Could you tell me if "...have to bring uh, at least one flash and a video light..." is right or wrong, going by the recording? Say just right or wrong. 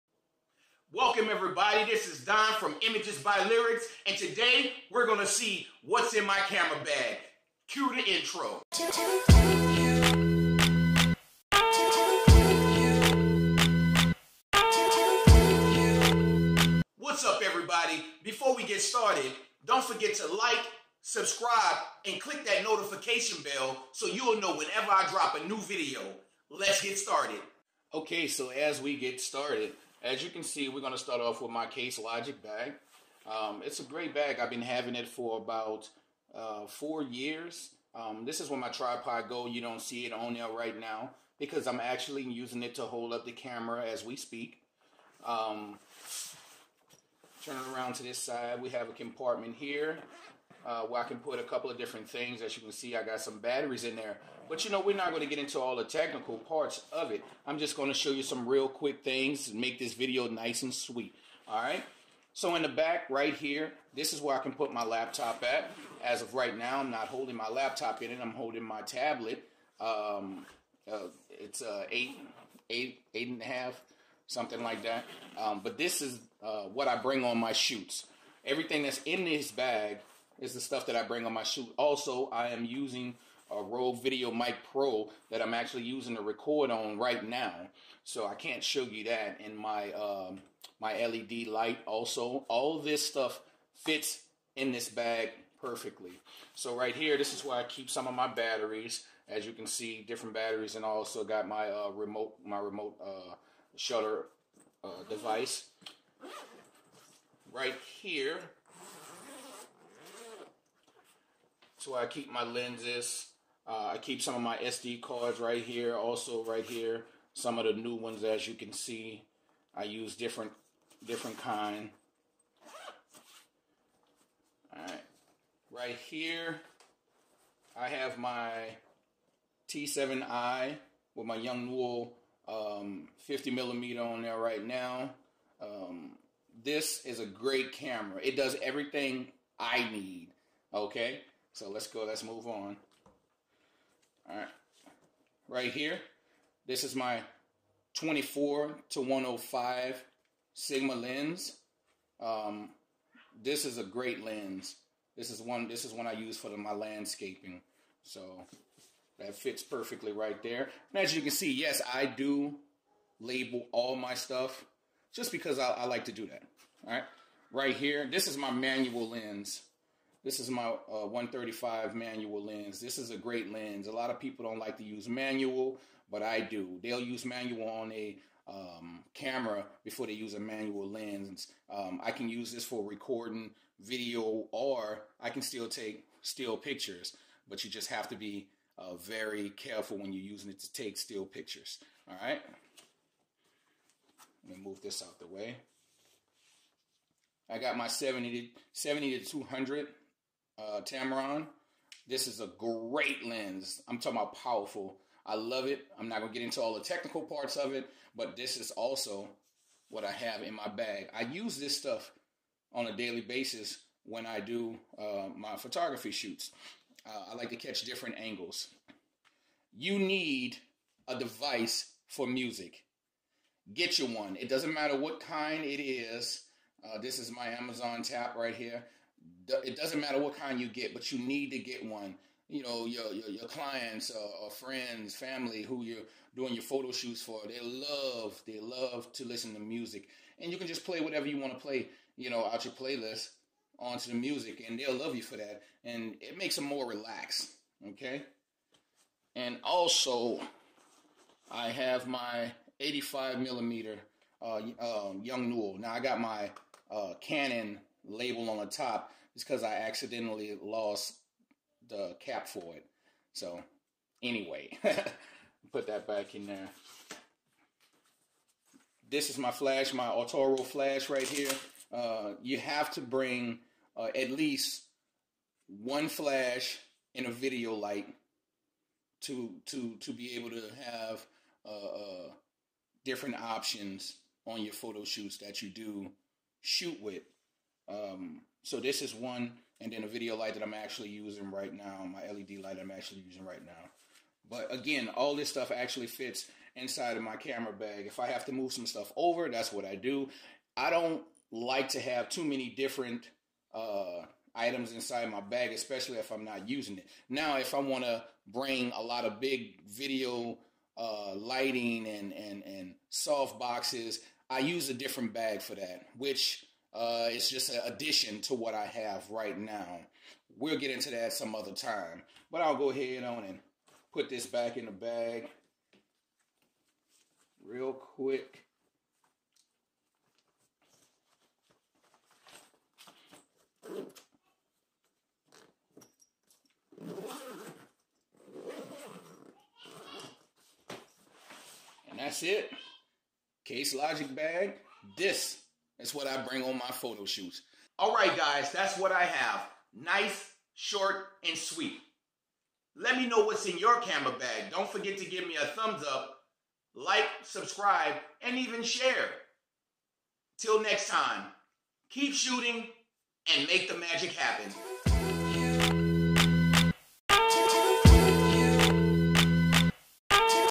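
right.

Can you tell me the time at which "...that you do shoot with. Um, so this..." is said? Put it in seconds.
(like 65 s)
285 s.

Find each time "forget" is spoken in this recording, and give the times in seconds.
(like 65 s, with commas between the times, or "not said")
19 s, 354 s.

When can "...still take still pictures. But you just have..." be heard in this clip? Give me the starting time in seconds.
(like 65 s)
185 s.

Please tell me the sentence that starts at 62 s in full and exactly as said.
So in the back right here, this is where I can put my laptop at.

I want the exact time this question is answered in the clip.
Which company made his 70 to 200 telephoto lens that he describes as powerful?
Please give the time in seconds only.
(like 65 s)
200 s.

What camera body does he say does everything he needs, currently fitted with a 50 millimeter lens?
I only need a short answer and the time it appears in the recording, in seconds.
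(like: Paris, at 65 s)
T7i, at 129 s.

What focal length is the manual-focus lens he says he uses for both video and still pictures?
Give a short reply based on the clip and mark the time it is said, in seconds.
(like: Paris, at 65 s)
135, at 171 s.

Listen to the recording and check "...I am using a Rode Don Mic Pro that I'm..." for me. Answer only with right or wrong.
wrong.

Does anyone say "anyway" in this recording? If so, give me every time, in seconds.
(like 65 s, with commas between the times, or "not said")
264 s.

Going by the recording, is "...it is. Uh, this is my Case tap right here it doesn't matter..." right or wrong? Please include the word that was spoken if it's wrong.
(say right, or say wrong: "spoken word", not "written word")
wrong: "Amazon", not "Case".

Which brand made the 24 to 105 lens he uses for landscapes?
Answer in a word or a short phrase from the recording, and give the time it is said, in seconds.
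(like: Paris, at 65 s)
Sigma, at 150 s.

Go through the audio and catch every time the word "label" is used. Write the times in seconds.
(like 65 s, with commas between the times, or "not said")
163 s, 258 s.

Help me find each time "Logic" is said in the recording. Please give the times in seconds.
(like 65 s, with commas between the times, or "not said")
31 s, 343 s.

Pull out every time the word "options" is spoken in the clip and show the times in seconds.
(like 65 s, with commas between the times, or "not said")
283 s.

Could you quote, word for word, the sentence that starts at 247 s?
Okay, and also, I have my 85 millimeter uh, um, Yongnuo.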